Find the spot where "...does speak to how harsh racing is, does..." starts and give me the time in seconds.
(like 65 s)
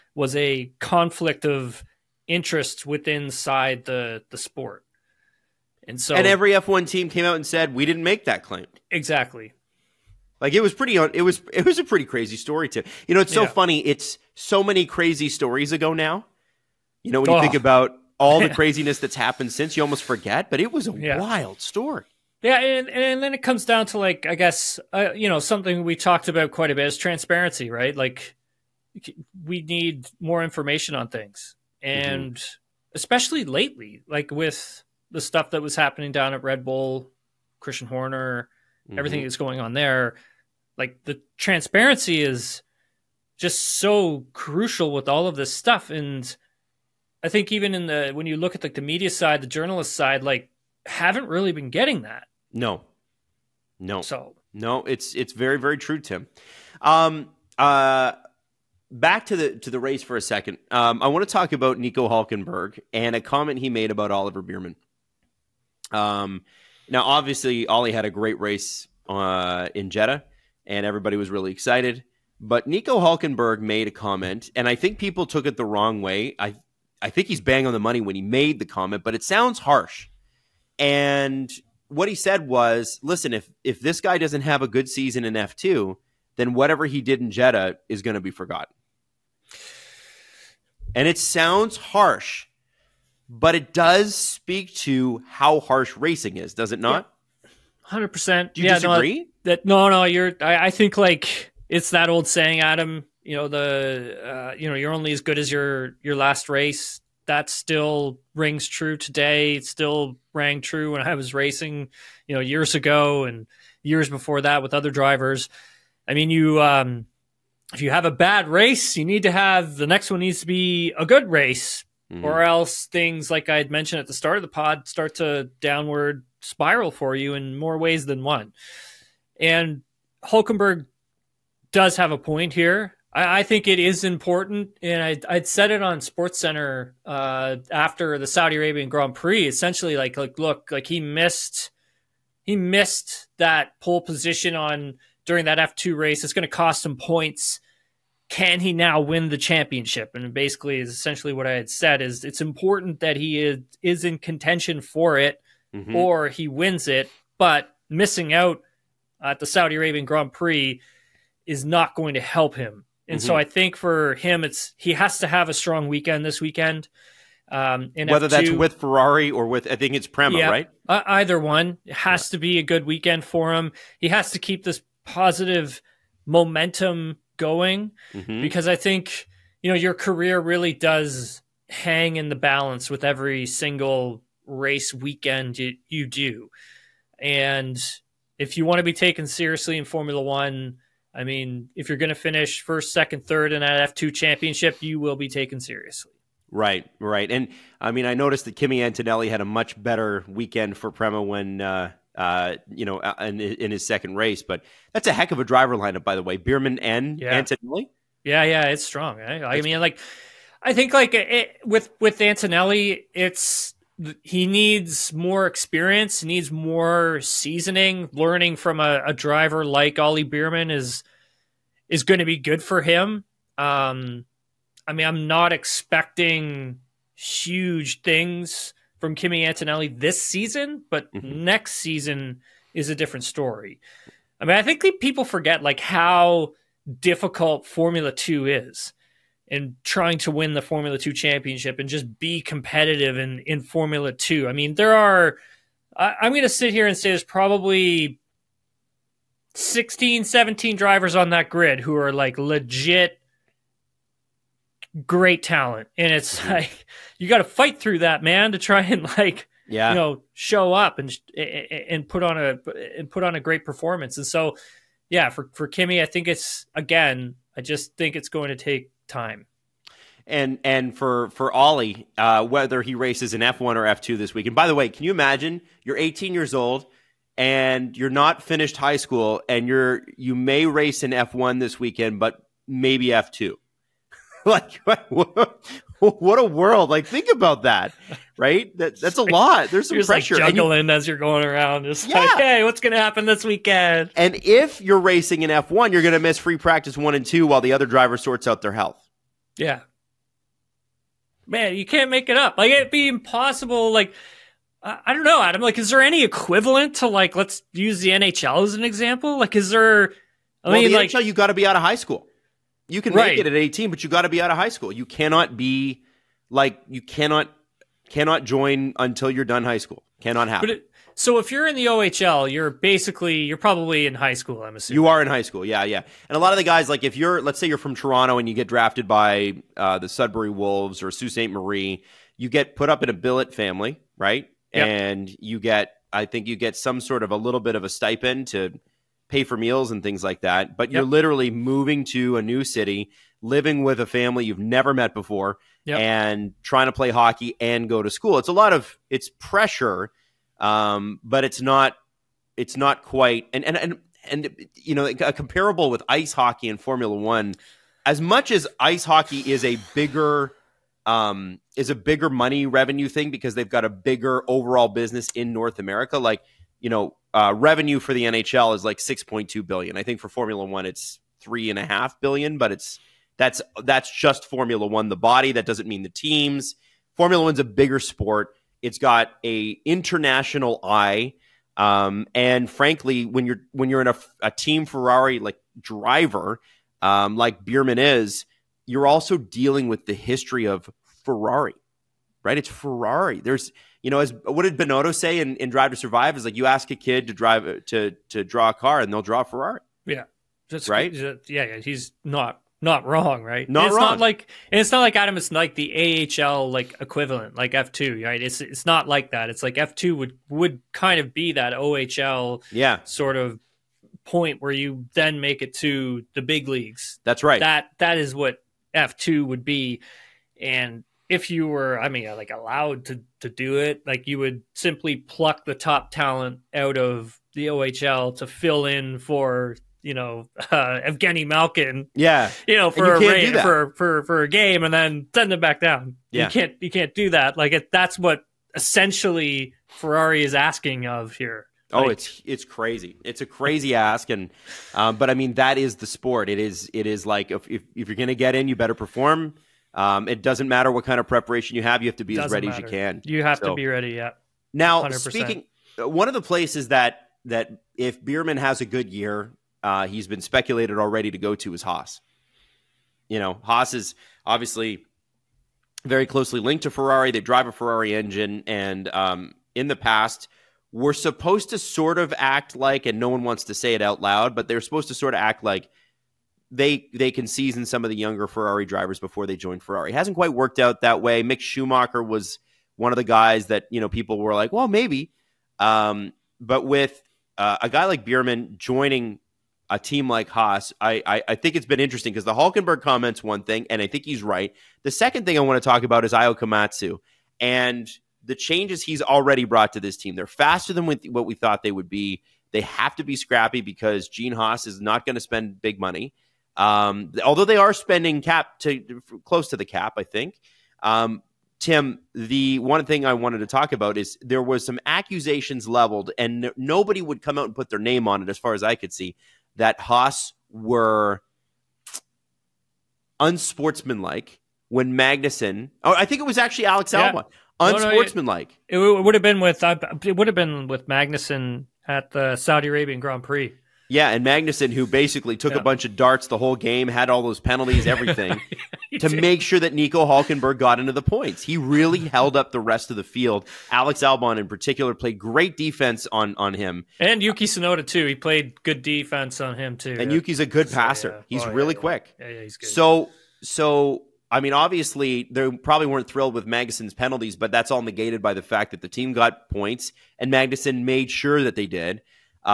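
93 s.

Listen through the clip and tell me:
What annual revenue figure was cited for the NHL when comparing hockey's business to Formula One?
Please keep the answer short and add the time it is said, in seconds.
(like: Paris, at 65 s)
6.2 billion, at 368 s.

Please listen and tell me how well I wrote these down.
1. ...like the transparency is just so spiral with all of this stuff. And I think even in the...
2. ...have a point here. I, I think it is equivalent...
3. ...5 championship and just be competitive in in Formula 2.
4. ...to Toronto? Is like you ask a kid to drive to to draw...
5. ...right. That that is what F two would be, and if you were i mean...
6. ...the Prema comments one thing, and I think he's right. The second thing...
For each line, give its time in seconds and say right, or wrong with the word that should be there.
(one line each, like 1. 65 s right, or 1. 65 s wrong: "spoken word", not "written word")
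1. 40 s wrong: "crucial", not "spiral"
2. 131 s wrong: "important", not "equivalent"
3. 240 s wrong: "2", not "5"
4. 395 s wrong: "Survive", not "Toronto"
5. 417 s right
6. 492 s wrong: "Hulkenberg", not "Prema".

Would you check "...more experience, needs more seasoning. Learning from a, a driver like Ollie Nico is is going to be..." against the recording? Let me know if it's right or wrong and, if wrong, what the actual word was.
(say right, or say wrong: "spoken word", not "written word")
wrong: "Bearman", not "Nico".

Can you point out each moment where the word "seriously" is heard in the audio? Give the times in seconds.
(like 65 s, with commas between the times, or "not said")
189 s, 195 s.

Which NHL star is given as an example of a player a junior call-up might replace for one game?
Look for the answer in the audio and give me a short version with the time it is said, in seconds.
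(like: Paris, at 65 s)
Evgeny Malkin, at 431 s.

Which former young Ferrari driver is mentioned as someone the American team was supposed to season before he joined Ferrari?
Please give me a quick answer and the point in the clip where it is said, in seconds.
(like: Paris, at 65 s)
Mick Schumacher, at 481 s.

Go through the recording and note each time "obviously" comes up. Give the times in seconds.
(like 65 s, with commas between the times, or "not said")
67 s, 464 s, 554 s.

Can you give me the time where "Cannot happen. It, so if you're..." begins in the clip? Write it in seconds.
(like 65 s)
320 s.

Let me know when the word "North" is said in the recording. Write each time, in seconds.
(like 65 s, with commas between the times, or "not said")
365 s.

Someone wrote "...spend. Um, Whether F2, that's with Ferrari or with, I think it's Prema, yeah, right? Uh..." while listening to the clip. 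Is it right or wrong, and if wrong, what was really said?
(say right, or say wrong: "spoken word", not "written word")
wrong: "weekend", not "spend".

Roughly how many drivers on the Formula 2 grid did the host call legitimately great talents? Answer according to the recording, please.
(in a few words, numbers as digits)
16 or 17.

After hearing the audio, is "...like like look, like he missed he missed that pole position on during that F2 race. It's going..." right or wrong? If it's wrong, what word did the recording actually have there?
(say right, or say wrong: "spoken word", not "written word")
right.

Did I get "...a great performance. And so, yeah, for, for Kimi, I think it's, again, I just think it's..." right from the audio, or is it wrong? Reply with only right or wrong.
right.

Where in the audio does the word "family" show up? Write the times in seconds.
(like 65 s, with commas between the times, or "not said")
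333 s, 344 s.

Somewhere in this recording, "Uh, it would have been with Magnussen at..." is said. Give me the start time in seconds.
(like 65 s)
529 s.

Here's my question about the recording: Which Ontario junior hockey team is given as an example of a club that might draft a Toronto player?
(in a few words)
Sudbury Wolves.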